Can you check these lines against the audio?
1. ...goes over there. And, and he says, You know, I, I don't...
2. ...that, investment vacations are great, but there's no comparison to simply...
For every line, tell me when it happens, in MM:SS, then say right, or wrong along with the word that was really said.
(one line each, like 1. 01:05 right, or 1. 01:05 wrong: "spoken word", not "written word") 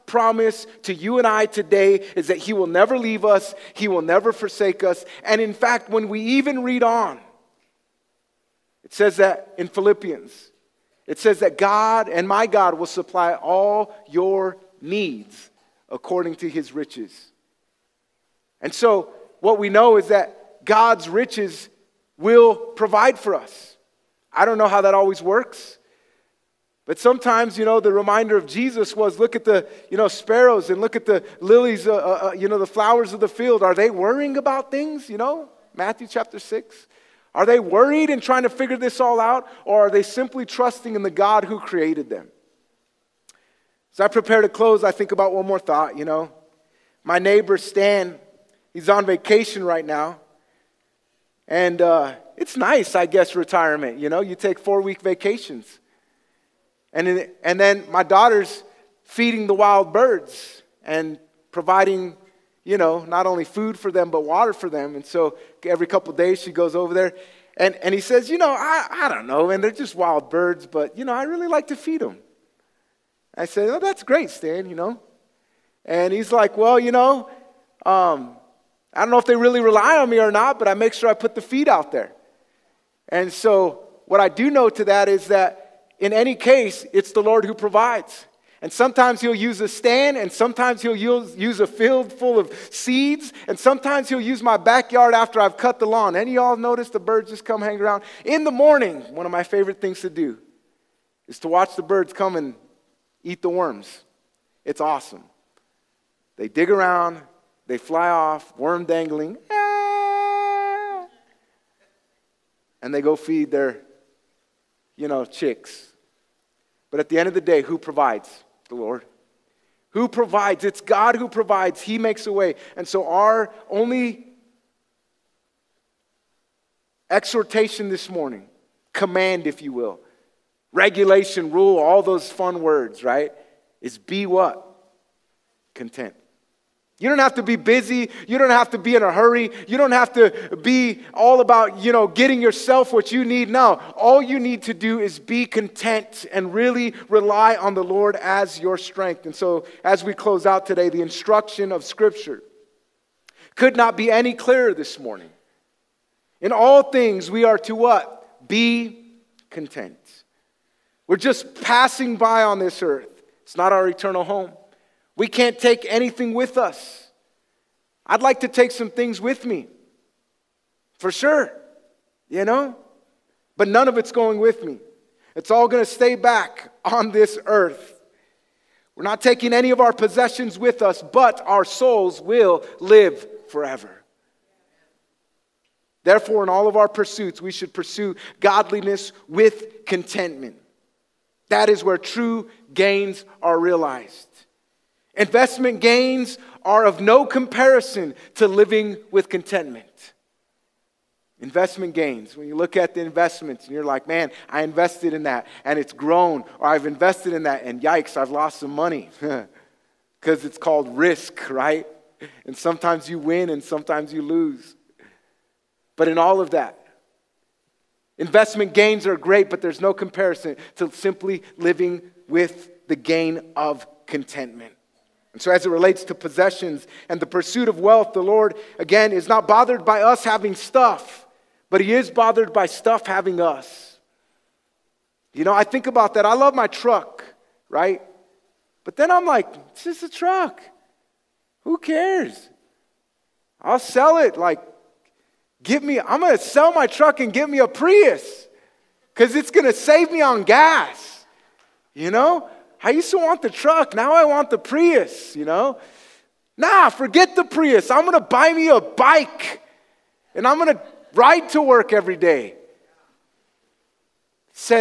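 1. 01:06 right
2. 03:36 wrong: "gains", not "vacations".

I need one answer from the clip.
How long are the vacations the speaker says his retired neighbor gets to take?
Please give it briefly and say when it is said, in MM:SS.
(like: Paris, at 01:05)
4 weeks, at 00:54.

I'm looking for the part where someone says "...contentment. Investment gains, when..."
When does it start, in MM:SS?
03:19.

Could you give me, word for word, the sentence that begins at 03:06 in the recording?
Therefore, in all of our pursuits, we should pursue godliness with contentment.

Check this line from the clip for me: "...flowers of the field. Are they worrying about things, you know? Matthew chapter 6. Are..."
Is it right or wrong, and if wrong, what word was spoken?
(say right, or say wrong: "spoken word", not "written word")
right.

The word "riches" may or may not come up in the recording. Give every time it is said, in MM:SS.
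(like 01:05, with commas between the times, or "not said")
00:16, 00:21.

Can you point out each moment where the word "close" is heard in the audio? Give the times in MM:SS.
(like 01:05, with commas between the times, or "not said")
00:44, 02:30.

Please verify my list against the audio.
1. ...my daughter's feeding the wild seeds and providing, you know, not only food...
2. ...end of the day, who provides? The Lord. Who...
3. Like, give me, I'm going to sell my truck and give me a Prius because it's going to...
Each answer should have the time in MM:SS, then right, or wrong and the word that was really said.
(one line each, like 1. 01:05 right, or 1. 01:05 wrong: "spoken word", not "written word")
1. 00:57 wrong: "birds", not "seeds"
2. 01:57 right
3. 04:04 right.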